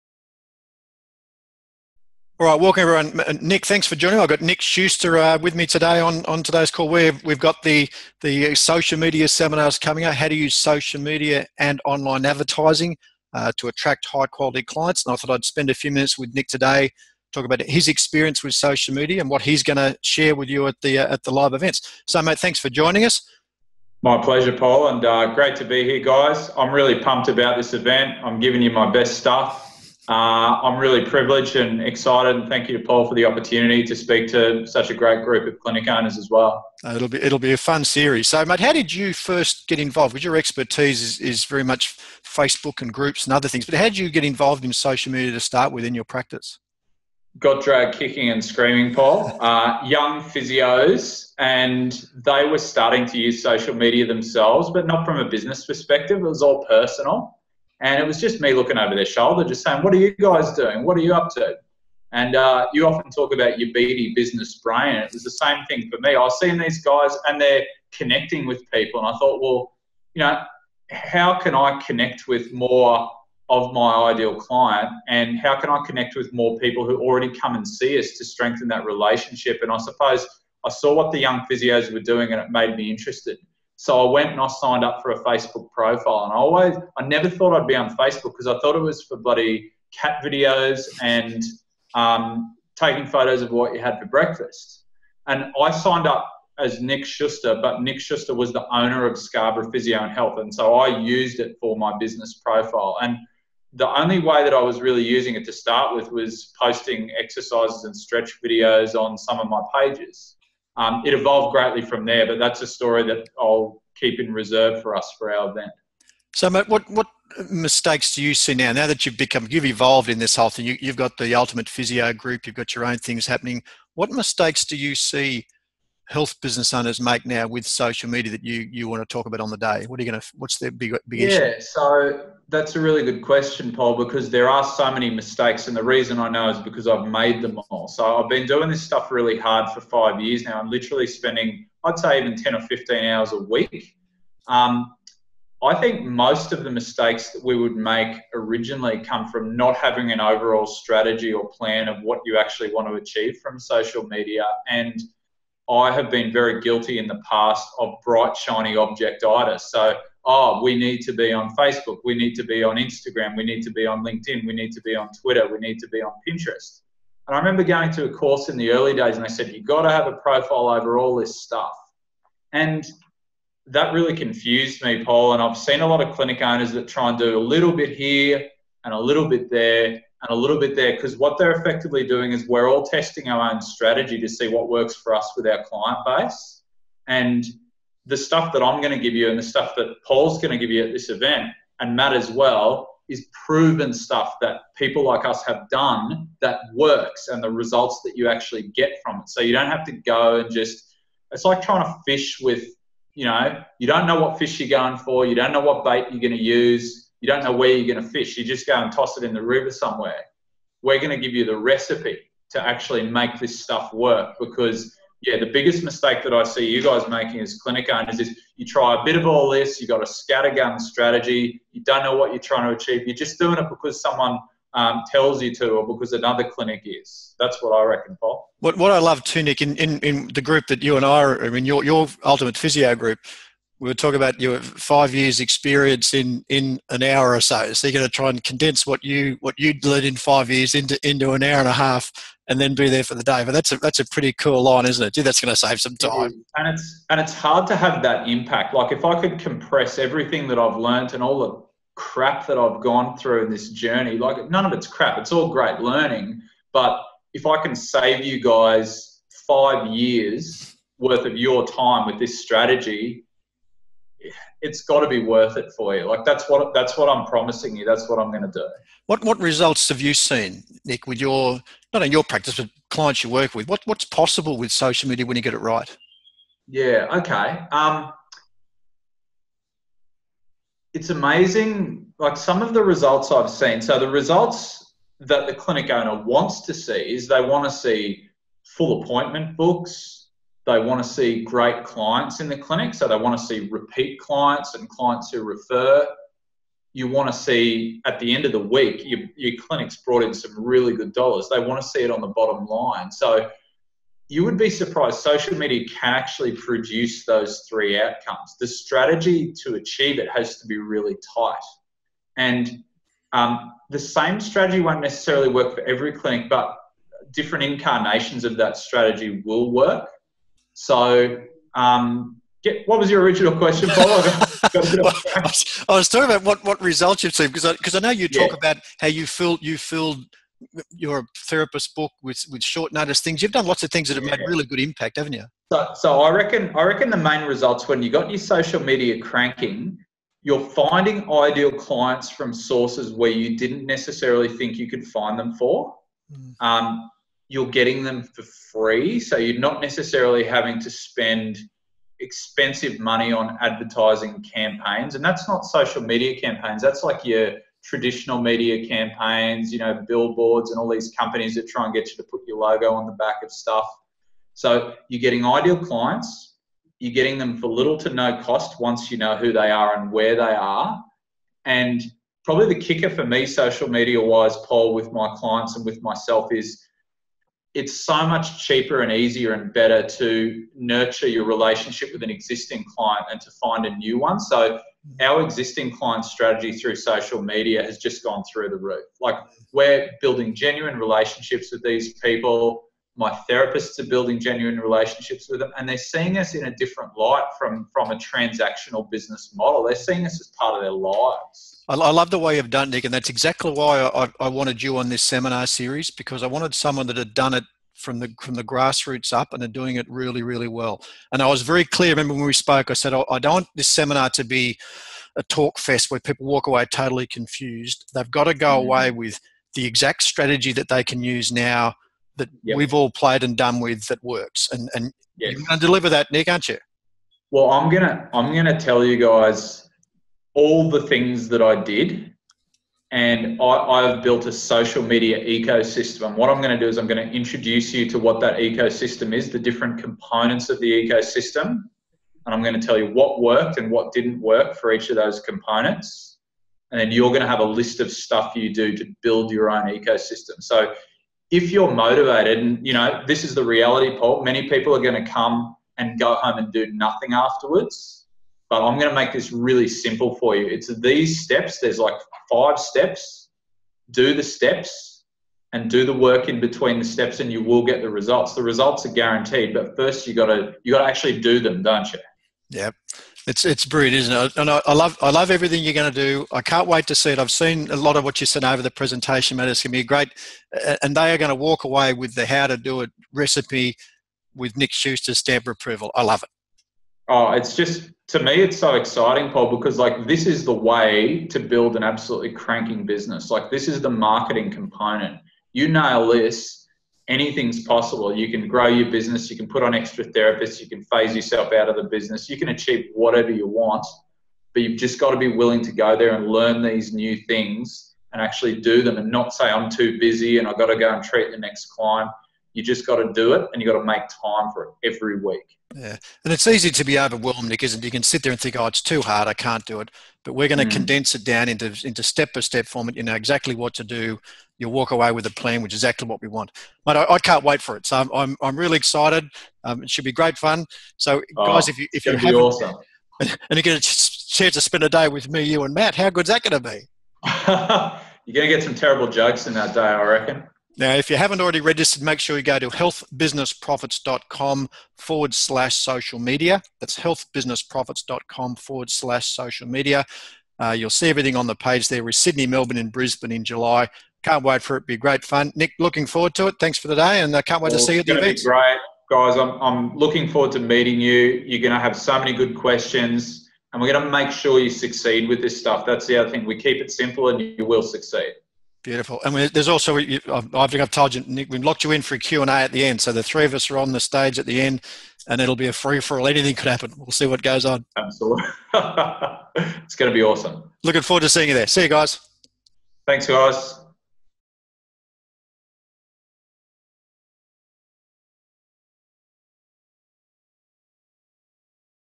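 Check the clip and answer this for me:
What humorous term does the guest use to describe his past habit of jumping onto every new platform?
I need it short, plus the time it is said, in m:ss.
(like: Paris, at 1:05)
Bright, shiny objectitis, at 2:38.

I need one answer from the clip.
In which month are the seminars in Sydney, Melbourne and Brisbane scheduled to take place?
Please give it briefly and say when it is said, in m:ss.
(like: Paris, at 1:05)
July, at 9:13.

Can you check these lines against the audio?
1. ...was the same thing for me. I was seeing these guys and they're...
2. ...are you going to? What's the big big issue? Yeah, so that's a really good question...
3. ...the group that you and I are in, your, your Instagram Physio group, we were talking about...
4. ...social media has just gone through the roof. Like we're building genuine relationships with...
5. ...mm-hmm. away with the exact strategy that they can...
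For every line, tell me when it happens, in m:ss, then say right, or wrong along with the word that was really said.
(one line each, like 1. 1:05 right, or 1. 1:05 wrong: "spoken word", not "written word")
1. 1:05 right
2. 2:09 right
3. 3:50 wrong: "Ultimate", not "Instagram"
4. 6:26 right
5. 6:58 right.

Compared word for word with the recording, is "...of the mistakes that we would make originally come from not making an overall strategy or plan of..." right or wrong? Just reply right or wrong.
wrong.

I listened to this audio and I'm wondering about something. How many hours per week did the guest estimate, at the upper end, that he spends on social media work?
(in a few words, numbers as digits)
15.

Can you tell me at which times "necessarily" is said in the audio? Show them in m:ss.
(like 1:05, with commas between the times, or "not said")
5:15, 5:43, 5:49.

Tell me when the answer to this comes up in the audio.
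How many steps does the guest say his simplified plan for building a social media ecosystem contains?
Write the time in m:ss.
7:42.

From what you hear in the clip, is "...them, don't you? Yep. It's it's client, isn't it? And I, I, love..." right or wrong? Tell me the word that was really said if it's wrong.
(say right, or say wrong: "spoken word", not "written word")
wrong: "brilliant", not "client".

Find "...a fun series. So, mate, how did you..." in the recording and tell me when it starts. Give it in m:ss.
0:37.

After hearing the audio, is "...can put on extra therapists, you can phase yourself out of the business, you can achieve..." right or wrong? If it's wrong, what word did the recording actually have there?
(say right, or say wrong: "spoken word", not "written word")
right.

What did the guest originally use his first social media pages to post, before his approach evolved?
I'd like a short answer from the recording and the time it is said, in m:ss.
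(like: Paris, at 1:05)
Exercises and stretch videos, at 1:47.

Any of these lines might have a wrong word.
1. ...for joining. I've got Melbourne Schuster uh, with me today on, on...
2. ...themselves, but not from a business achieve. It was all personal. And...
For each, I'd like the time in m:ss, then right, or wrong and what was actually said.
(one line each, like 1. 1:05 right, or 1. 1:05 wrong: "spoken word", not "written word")
1. 0:03 wrong: "Nick", not "Melbourne"
2. 0:54 wrong: "perspective", not "achieve".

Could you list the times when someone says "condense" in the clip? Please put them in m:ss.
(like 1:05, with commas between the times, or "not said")
3:58, 8:40.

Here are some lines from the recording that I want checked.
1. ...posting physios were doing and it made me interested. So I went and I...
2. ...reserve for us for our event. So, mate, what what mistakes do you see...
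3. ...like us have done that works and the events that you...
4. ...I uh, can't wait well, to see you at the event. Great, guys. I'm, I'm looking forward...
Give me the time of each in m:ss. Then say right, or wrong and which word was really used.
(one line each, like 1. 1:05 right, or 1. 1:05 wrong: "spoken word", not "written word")
1. 1:21 wrong: "young", not "posting"
2. 1:54 right
3. 3:15 wrong: "results", not "events"
4. 9:17 right.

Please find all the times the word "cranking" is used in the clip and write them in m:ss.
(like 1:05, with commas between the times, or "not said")
5:39, 8:12.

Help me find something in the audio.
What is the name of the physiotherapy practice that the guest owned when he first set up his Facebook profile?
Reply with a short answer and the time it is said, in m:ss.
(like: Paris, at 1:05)
Scarborough Physio and Health, at 1:39.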